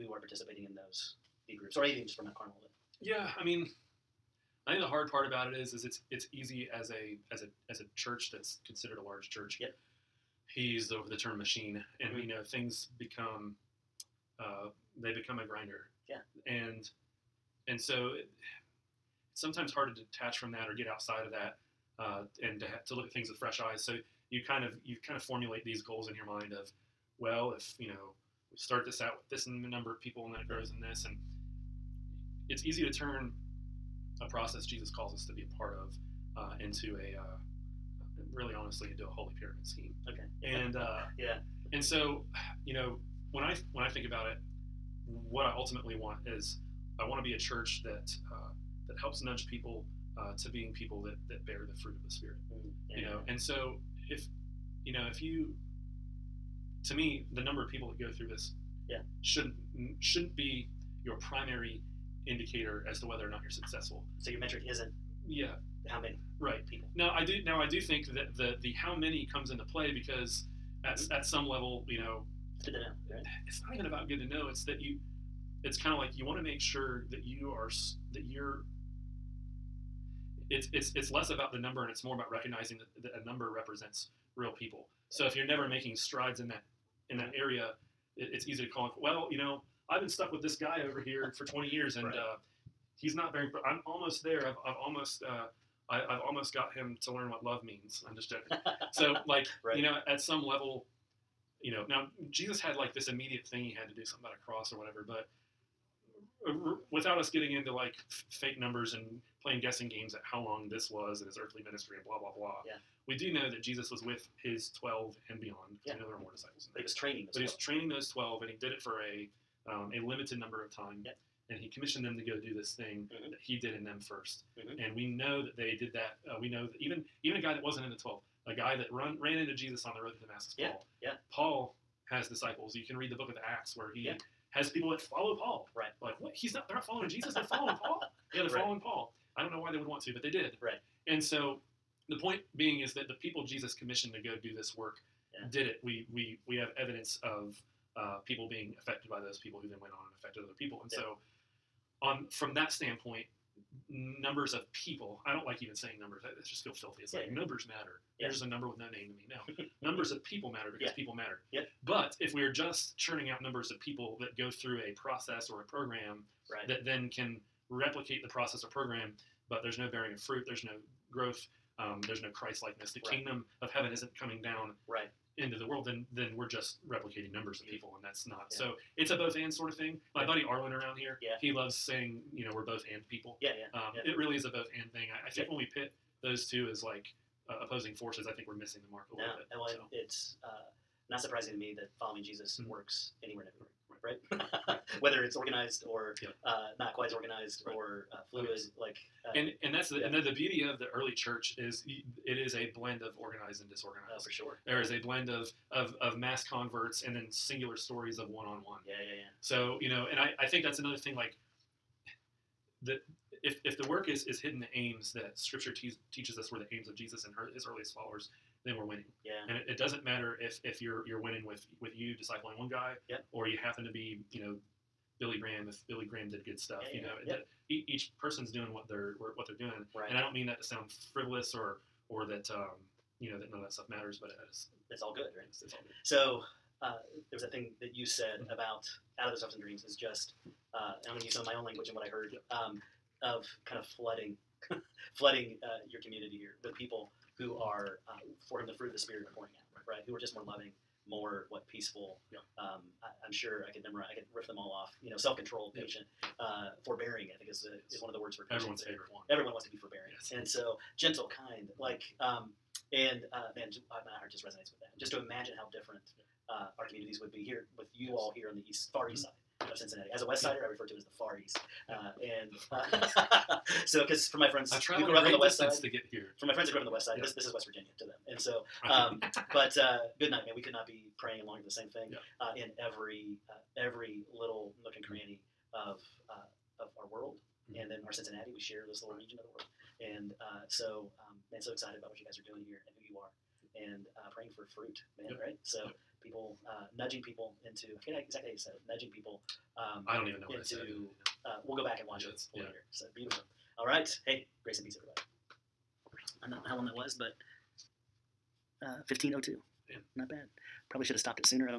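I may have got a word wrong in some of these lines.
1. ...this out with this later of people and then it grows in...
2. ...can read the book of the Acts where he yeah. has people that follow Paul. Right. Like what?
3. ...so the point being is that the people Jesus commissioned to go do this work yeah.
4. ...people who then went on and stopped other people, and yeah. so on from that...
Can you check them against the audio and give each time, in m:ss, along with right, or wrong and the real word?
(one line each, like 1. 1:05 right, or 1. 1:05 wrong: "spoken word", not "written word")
1. 0:28 wrong: "number", not "later"
2. 2:12 right
3. 2:21 right
4. 2:29 wrong: "affected", not "stopped".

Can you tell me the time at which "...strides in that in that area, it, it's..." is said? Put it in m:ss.
1:25.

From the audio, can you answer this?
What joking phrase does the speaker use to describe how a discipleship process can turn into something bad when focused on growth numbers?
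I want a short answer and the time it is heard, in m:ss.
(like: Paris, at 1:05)
holy pyramid scheme, at 0:39.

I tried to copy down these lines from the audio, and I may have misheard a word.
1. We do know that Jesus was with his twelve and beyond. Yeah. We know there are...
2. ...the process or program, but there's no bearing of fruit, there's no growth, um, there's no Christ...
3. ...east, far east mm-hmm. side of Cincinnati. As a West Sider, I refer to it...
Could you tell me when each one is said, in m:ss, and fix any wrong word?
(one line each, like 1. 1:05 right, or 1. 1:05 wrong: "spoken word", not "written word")
1. 1:53 right
2. 2:48 right
3. 4:28 right.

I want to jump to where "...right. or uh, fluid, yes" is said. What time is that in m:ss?
3:17.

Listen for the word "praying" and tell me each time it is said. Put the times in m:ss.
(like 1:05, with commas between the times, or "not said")
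4:41, 4:54.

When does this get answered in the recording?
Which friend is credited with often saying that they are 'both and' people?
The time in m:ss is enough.
3:00.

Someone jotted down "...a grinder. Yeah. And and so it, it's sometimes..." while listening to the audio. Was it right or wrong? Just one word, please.
right.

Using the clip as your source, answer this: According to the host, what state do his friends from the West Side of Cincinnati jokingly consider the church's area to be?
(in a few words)
West Virginia.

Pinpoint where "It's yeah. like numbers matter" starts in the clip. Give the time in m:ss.
2:37.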